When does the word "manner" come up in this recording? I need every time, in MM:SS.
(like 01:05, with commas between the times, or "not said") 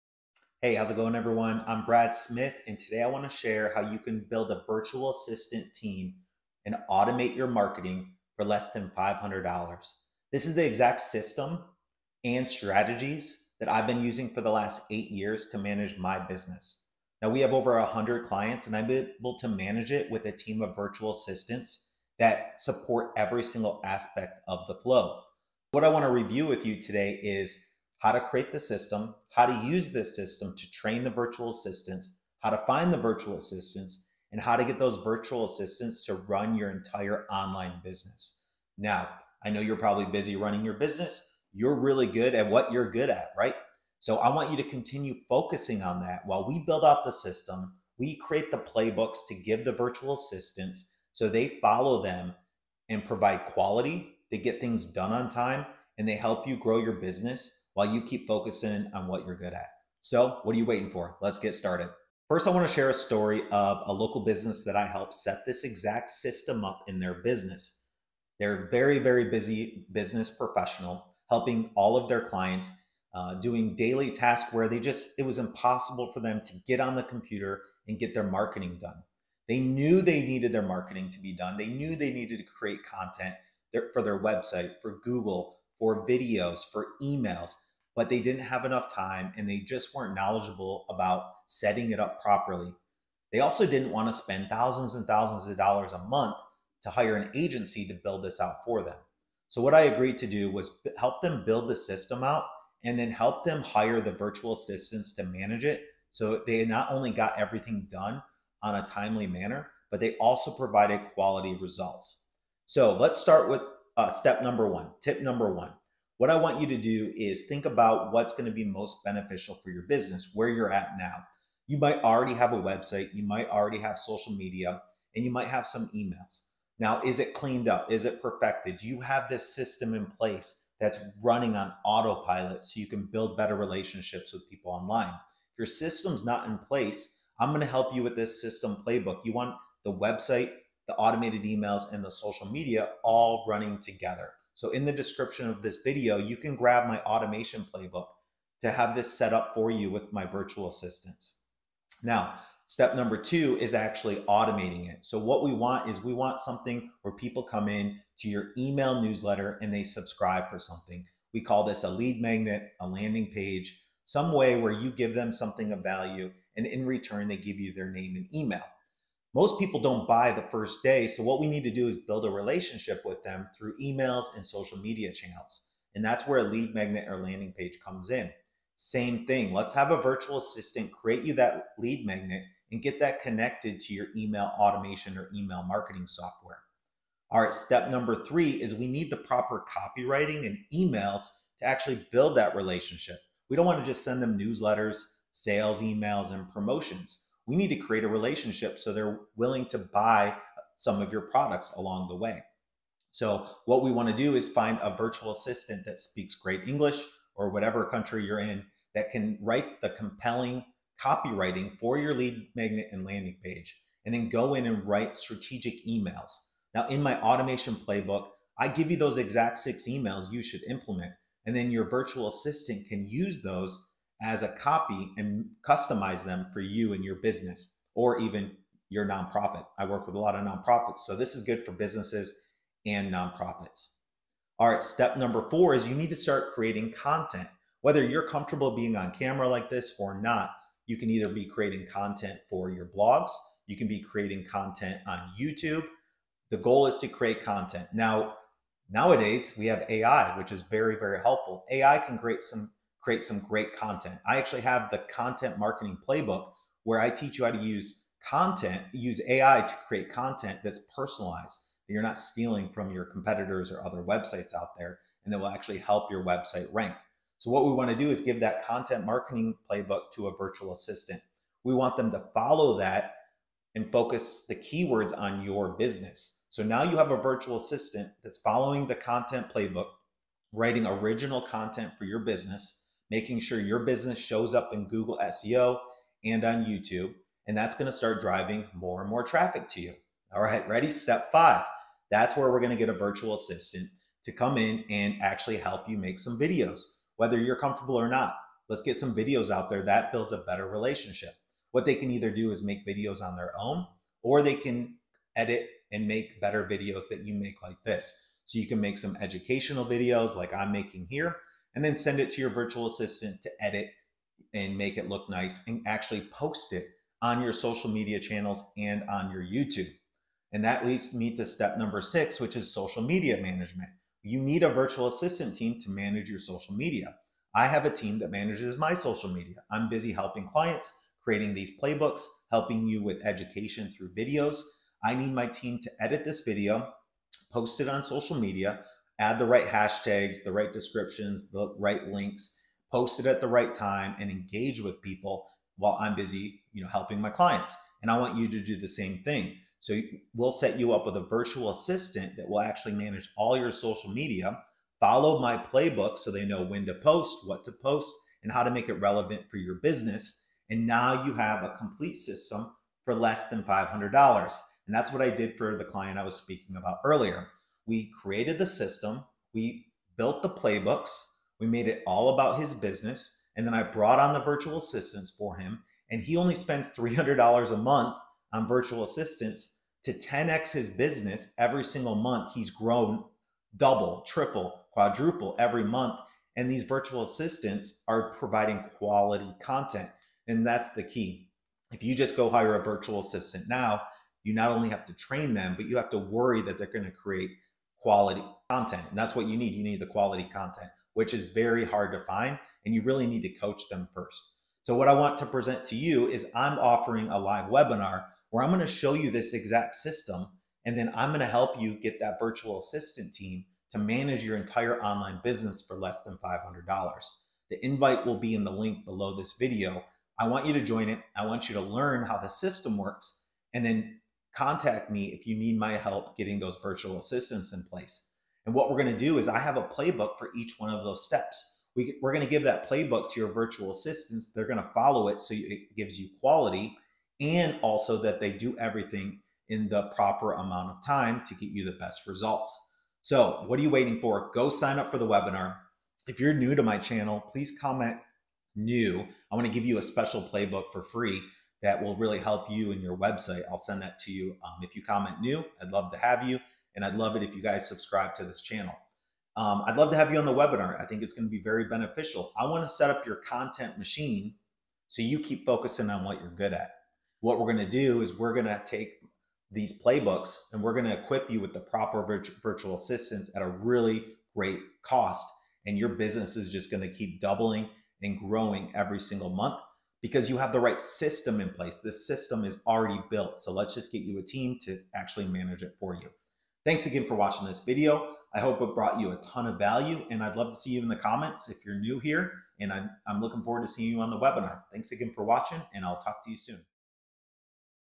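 01:49.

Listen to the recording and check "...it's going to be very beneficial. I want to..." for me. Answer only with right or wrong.
right.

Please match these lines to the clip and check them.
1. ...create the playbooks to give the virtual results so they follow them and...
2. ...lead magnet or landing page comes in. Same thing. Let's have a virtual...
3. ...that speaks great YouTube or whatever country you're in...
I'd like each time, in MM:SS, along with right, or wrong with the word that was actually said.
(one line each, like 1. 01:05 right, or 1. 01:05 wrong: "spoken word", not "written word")
1. 00:48 wrong: "assistants", not "results"
2. 02:56 right
3. 03:25 wrong: "English", not "YouTube".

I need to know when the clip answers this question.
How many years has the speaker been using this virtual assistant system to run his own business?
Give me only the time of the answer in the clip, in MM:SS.
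00:14.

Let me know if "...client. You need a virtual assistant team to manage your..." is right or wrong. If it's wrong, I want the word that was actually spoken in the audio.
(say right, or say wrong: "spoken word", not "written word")
wrong: "management", not "client".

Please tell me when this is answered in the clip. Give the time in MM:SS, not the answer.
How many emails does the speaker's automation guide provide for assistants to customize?
03:39.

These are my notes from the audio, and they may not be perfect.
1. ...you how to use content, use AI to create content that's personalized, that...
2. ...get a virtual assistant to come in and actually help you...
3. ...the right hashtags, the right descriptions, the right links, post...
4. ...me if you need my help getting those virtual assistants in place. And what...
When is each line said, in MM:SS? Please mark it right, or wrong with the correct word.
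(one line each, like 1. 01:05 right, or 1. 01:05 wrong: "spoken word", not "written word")
1. 04:17 right
2. 04:52 right
3. 05:39 right
4. 07:05 right.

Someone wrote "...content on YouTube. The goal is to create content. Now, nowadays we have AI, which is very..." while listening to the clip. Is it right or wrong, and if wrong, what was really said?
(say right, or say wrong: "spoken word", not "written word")
right.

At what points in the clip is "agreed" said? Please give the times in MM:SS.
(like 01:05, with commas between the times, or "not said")
01:39.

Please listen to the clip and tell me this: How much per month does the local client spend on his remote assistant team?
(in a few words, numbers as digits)
$300.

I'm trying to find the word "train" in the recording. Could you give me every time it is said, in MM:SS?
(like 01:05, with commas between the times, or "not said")
00:30, 06:35.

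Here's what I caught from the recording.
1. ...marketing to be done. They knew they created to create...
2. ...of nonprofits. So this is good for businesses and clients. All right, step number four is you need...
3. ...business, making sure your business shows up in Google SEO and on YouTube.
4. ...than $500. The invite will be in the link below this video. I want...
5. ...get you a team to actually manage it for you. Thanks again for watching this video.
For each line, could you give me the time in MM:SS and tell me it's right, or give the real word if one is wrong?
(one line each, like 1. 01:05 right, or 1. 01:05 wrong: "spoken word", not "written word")
1. 01:20 wrong: "needed", not "created"
2. 03:50 wrong: "nonprofits", not "clients"
3. 04:42 right
4. 06:56 right
5. 08:04 right.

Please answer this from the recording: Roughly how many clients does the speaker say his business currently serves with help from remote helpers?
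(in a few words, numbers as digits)
over 100.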